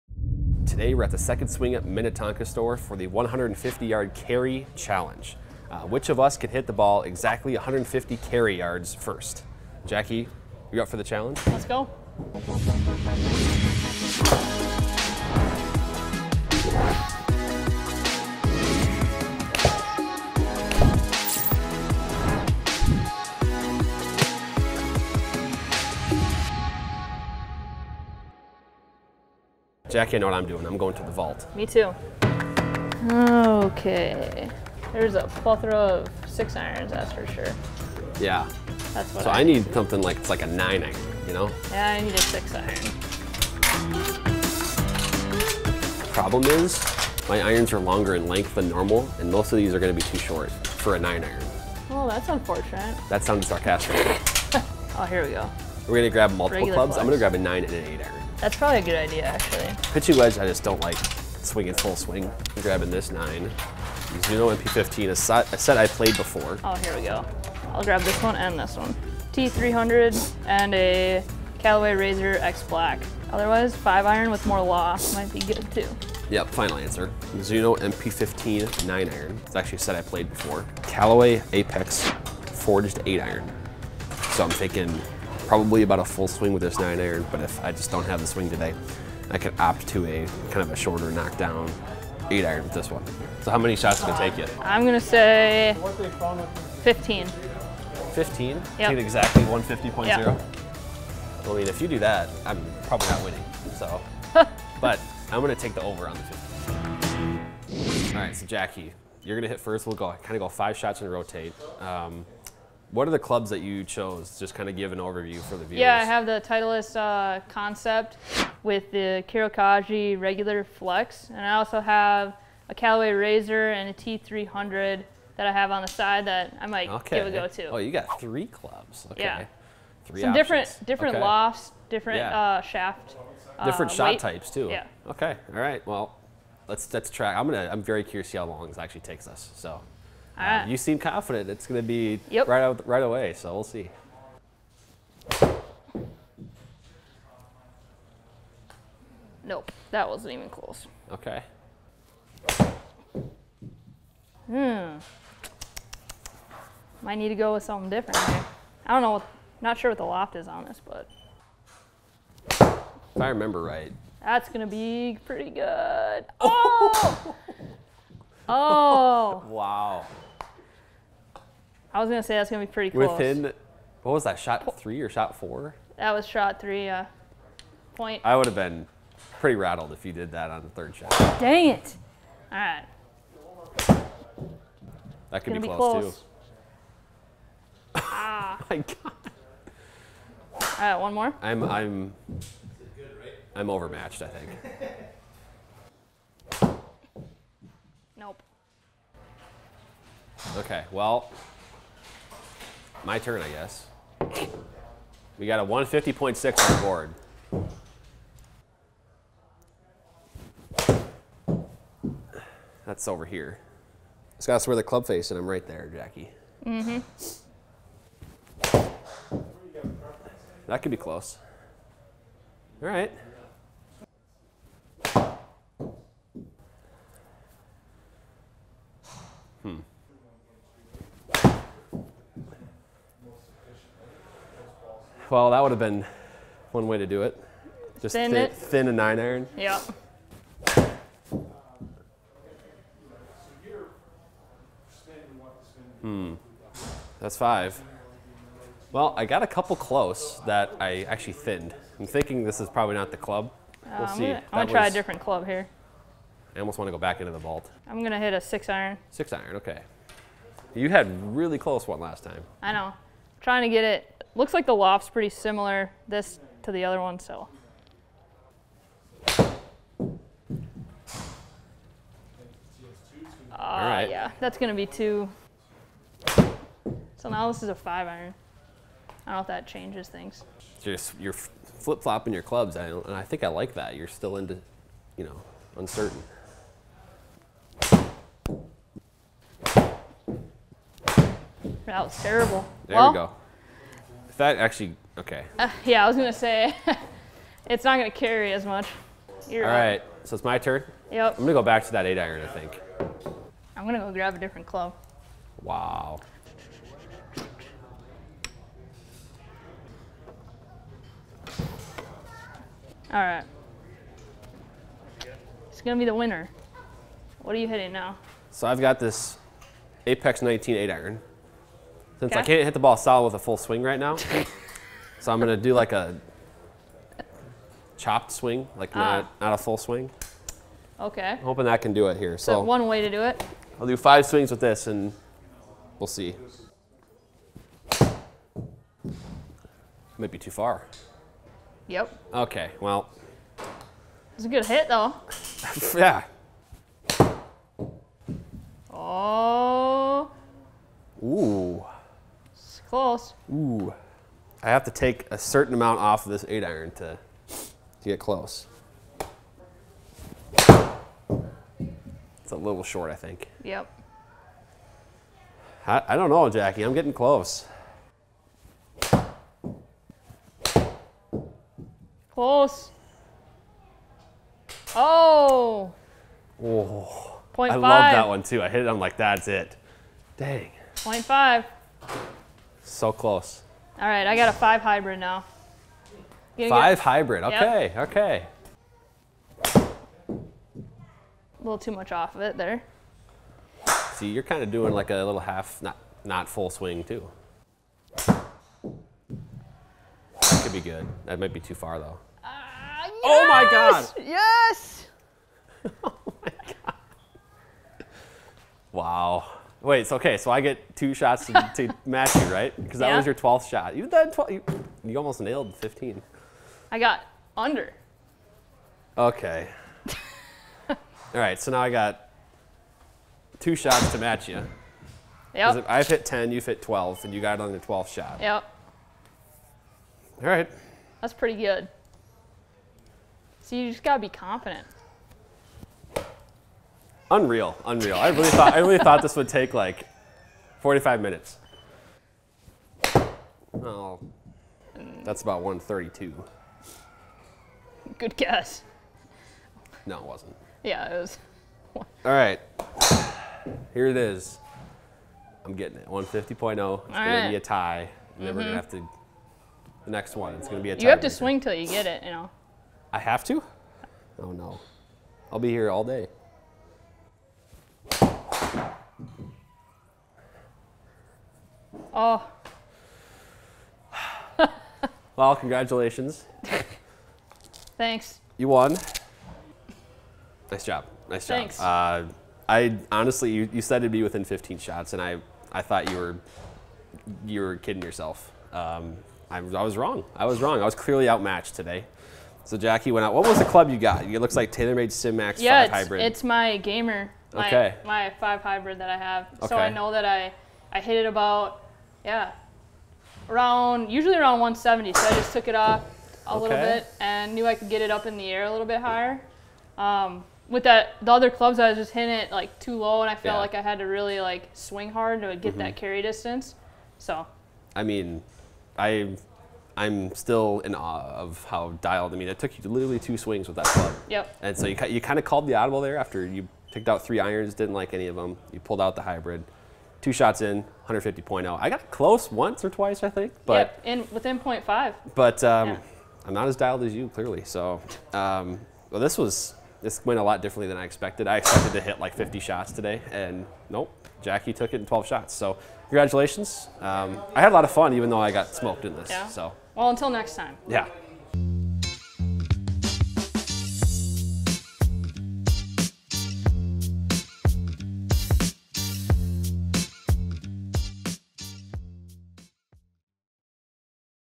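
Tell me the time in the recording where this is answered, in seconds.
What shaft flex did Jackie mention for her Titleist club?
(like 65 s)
120 s.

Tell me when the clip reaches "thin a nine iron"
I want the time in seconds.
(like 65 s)
238 s.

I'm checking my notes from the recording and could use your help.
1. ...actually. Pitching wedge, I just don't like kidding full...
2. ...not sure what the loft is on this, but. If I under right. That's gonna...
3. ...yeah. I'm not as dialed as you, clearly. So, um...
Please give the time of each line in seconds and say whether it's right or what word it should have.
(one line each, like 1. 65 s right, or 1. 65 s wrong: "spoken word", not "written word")
1. 59 s wrong: "swinging", not "kidding"
2. 159 s wrong: "remember", not "under"
3. 535 s right.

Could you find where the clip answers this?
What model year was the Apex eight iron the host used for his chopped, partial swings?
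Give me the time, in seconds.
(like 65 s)
320 s.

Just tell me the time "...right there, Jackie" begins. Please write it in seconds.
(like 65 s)
215 s.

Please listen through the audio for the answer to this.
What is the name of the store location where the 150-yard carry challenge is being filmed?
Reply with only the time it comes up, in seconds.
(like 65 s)
1 s.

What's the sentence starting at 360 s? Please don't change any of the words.
It's a little short, I think.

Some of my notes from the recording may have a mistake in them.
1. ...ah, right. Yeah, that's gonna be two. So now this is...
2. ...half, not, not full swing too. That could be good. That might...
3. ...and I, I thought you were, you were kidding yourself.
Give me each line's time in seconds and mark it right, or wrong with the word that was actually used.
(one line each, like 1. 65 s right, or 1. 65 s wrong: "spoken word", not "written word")
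1. 273 s right
2. 395 s right
3. 485 s right.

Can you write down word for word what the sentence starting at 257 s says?
I'm gonna hit a six iron.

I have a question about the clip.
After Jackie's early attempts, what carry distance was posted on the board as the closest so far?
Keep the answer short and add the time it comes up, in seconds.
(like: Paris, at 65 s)
150.6, at 205 s.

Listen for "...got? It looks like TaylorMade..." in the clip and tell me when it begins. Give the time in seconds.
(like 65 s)
493 s.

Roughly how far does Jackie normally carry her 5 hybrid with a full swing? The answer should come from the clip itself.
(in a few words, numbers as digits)
170 yards.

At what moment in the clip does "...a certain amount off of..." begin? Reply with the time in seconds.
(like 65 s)
355 s.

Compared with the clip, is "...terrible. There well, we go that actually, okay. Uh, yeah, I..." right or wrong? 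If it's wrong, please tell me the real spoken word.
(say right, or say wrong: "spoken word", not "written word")
right.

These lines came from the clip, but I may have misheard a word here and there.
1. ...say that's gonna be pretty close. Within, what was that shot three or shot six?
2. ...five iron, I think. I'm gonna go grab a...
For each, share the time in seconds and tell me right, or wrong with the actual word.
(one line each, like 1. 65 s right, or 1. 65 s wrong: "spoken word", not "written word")
1. 172 s wrong: "four", not "six"
2. 302 s wrong: "eight", not "five".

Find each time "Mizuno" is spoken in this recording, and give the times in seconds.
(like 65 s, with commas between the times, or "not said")
64 s, 77 s.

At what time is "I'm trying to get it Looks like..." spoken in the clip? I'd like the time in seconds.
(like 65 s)
262 s.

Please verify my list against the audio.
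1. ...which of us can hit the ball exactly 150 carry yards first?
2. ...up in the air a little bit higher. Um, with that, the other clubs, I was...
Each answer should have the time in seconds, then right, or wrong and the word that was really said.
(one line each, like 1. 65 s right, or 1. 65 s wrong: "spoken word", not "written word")
1. 5 s right
2. 508 s right.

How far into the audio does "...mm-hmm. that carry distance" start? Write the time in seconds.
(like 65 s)
515 s.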